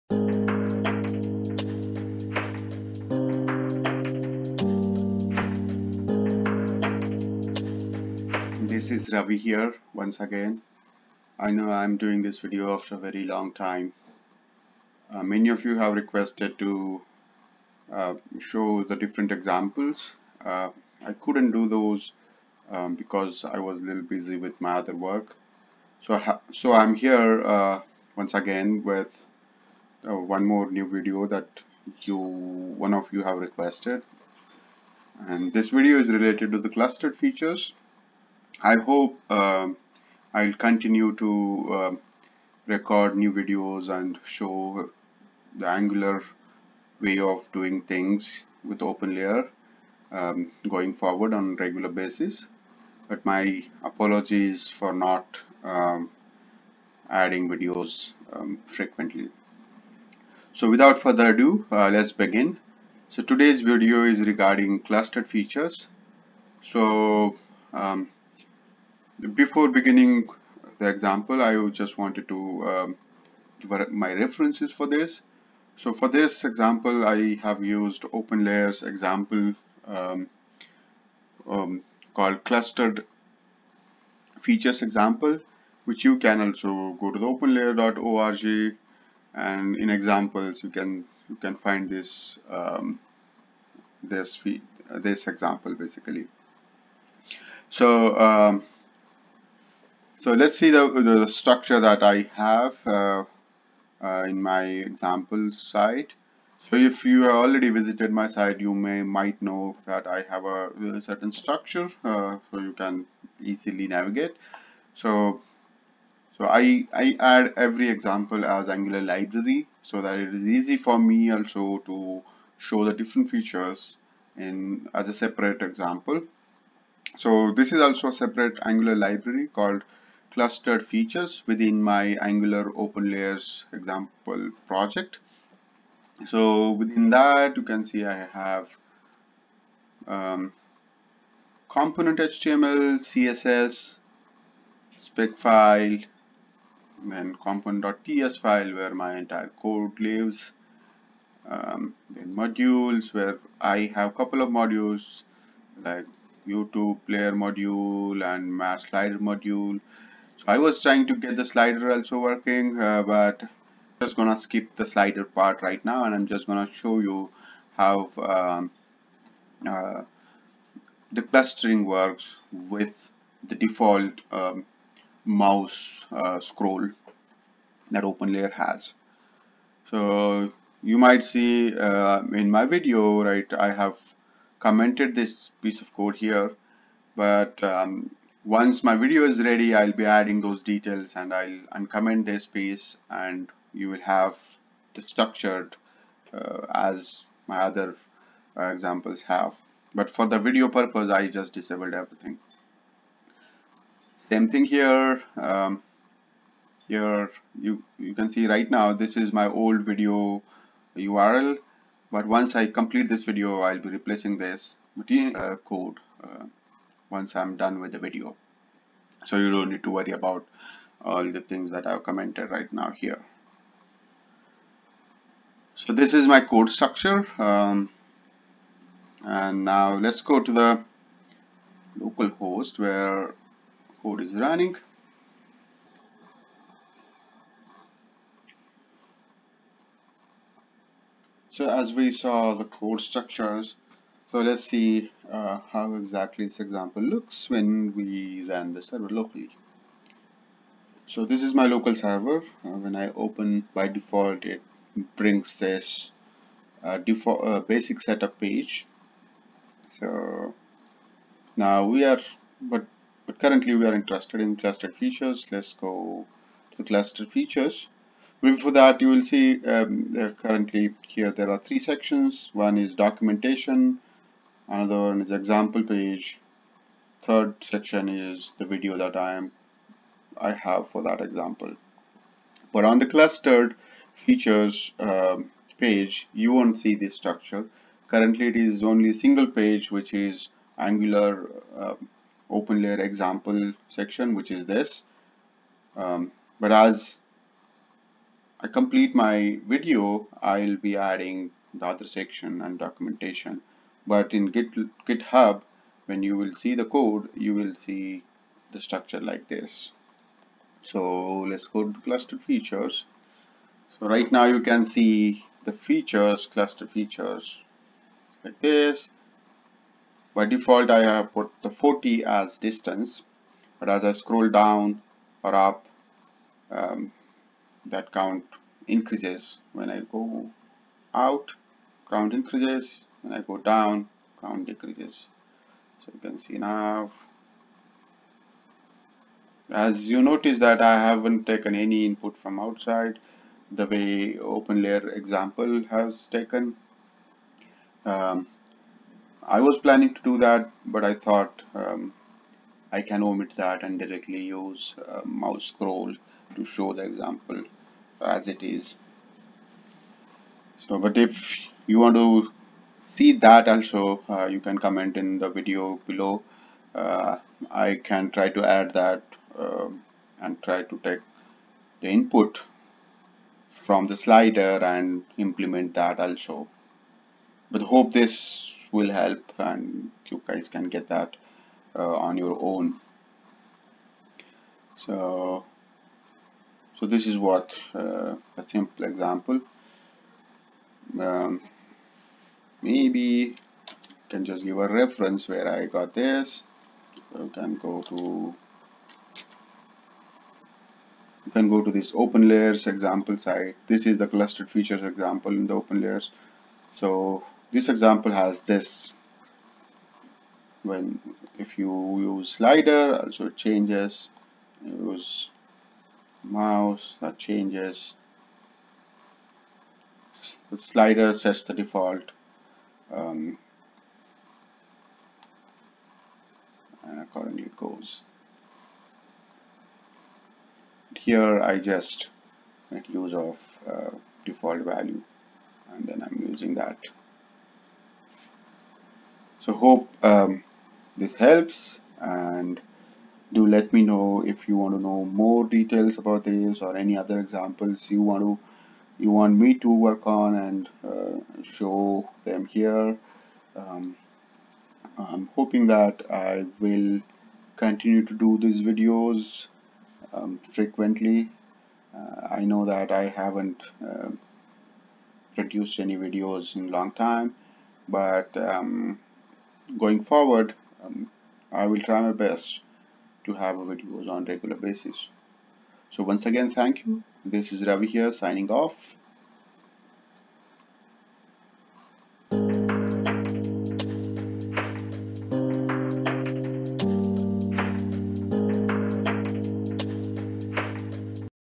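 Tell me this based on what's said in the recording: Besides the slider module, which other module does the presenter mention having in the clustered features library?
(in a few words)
YouTube player module.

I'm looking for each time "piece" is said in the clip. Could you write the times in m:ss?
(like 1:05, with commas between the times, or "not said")
3:05, 3:12.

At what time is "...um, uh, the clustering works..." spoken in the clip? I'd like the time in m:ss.
2:48.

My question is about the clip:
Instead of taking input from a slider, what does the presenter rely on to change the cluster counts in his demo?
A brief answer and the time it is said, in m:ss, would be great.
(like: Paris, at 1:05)
mouse scroll, at 5:55.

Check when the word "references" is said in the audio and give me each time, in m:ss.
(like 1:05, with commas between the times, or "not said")
1:14, 6:34.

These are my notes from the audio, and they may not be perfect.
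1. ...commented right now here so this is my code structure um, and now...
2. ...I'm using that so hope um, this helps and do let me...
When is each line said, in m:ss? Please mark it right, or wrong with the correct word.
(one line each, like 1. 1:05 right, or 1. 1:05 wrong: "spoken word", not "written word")
1. 3:42 right
2. 7:16 right.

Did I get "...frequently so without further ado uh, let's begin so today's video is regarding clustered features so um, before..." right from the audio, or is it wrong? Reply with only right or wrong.
right.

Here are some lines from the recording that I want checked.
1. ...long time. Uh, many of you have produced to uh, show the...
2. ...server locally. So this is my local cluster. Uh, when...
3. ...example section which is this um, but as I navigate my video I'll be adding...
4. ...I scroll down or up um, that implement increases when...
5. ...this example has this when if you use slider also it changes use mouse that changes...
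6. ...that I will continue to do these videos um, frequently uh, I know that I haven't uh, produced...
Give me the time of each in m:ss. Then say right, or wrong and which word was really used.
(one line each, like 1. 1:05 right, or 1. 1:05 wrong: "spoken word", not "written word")
1. 0:13 wrong: "requested", not "produced"
2. 4:08 wrong: "server", not "cluster"
3. 4:53 wrong: "complete", not "navigate"
4. 5:24 wrong: "count", not "implement"
5. 6:47 right
6. 7:35 right.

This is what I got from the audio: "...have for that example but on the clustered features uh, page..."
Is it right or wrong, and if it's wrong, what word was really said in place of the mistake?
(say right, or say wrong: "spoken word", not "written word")
right.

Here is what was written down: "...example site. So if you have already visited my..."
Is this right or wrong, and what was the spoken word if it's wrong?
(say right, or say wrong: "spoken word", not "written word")
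right.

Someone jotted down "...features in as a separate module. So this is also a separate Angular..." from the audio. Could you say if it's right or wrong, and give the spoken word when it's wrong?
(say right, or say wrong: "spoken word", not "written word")
wrong: "example", not "module".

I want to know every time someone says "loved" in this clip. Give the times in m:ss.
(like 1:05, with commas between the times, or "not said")
not said.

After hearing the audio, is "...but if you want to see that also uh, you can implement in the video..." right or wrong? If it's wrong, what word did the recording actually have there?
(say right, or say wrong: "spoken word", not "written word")
wrong: "comment", not "implement".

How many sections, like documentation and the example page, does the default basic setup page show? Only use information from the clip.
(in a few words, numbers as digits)
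3.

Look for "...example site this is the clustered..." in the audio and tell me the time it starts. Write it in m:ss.
6:42.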